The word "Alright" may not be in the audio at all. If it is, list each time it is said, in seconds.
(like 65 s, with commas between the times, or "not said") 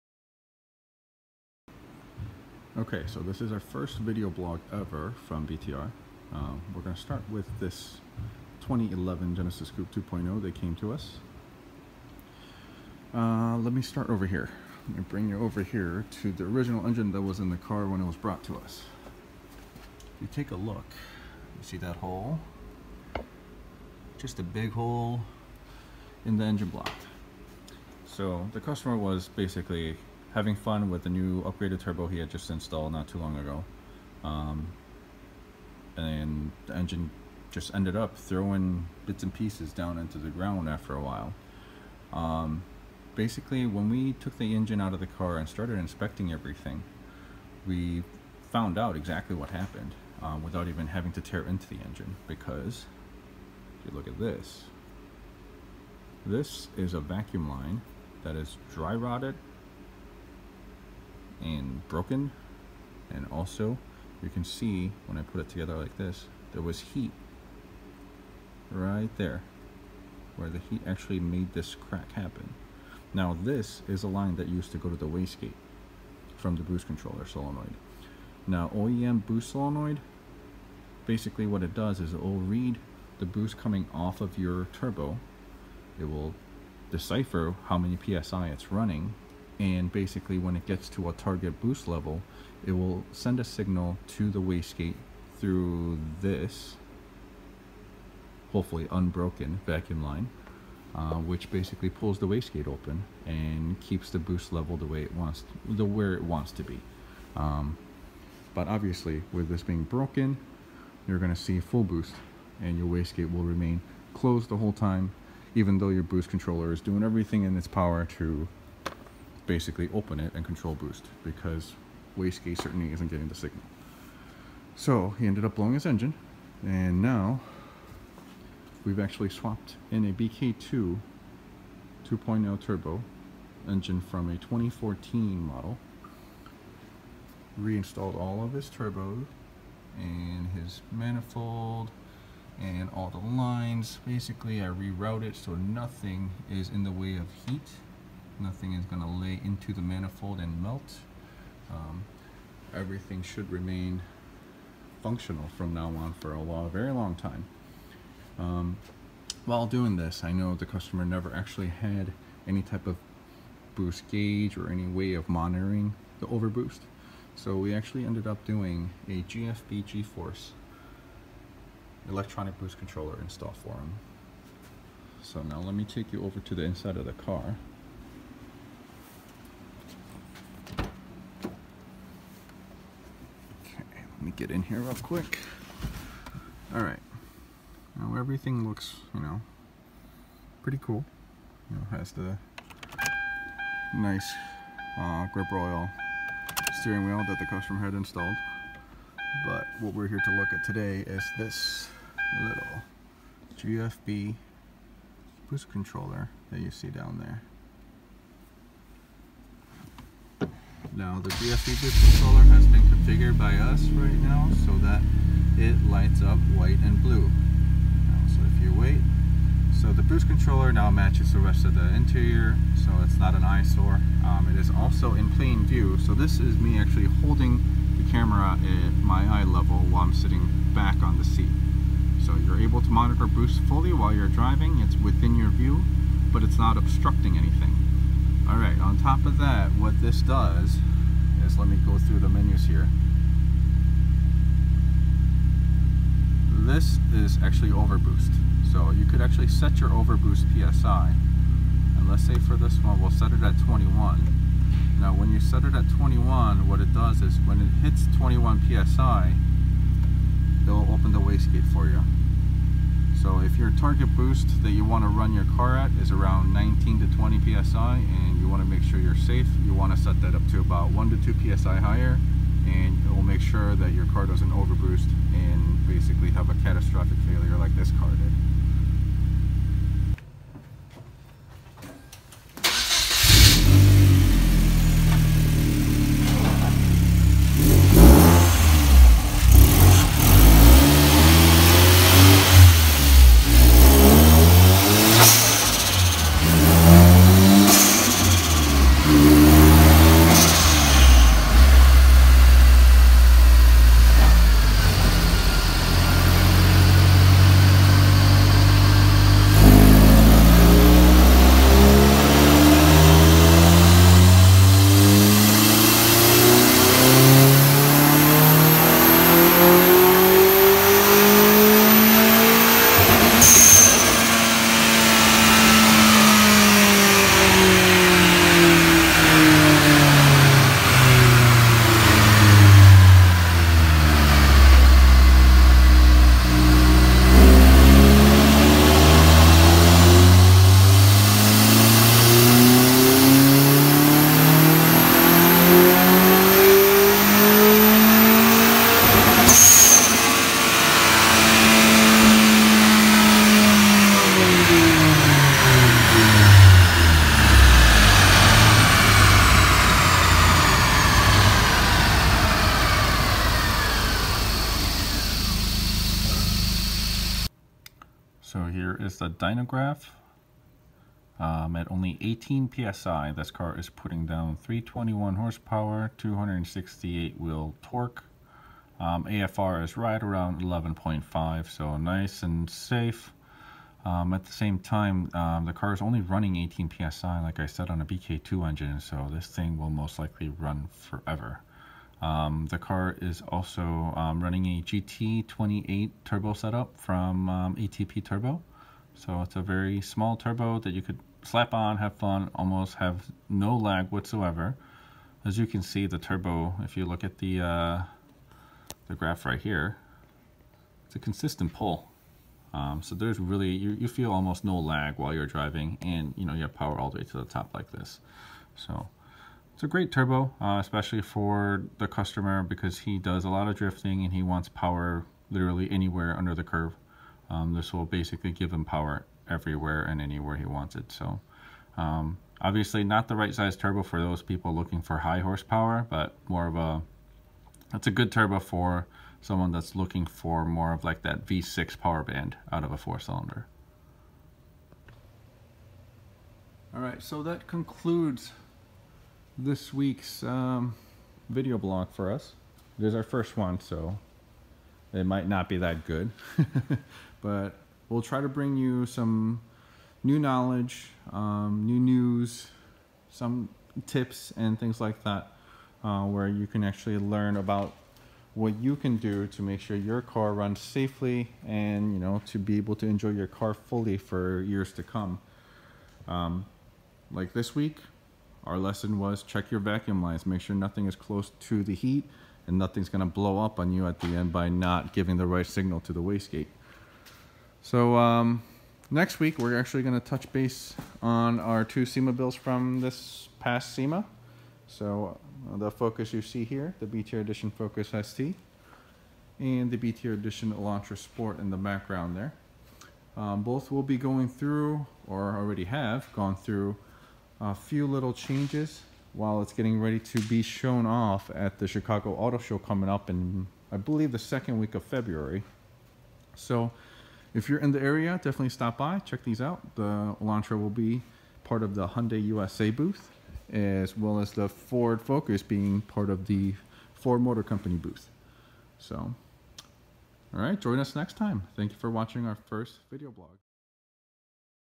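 238 s.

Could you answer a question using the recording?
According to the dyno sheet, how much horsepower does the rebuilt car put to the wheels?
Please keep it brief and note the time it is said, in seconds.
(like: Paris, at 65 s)
321, at 374 s.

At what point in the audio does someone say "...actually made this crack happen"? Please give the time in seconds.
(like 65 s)
70 s.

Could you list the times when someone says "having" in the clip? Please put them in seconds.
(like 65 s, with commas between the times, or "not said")
30 s, 50 s.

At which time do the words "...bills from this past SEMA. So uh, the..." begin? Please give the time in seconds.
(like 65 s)
492 s.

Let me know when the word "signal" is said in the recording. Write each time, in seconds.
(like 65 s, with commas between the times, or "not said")
93 s, 123 s, 485 s.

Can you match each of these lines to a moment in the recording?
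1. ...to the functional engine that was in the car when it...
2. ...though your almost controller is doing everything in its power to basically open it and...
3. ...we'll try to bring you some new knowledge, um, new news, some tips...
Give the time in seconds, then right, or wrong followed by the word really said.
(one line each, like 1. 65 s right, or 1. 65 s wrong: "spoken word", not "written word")
1. 16 s wrong: "original", not "functional"
2. 115 s wrong: "boost", not "almost"
3. 458 s right.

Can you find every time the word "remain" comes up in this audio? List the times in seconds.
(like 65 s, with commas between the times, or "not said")
113 s, 153 s.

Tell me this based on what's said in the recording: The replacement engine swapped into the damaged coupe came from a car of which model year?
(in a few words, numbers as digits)
2014.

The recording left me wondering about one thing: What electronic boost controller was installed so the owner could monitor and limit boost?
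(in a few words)
GFB G-Force.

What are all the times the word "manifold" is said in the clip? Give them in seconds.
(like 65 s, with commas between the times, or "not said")
140 s, 149 s.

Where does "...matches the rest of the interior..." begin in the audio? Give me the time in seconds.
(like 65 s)
220 s.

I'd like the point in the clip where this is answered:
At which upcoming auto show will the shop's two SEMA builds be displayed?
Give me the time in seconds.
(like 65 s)
511 s.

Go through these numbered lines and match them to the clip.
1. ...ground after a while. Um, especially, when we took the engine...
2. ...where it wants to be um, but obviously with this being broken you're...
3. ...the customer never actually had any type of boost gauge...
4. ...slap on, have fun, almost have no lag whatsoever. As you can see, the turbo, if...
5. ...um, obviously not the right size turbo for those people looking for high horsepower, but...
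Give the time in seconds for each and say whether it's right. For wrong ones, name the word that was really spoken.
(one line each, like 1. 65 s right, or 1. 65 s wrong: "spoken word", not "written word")
1. 40 s wrong: "basically", not "especially"
2. 105 s right
3. 160 s right
4. 401 s right
5. 431 s right.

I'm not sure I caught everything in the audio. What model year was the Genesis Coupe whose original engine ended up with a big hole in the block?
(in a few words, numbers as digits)
2011.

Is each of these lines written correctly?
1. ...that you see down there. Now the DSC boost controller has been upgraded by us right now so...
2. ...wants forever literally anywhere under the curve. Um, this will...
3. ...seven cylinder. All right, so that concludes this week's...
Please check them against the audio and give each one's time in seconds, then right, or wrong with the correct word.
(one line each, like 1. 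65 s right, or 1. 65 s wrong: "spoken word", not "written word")
1. 206 s wrong: "configured", not "upgraded"
2. 424 s wrong: "power", not "forever"
3. 442 s wrong: "four", not "seven".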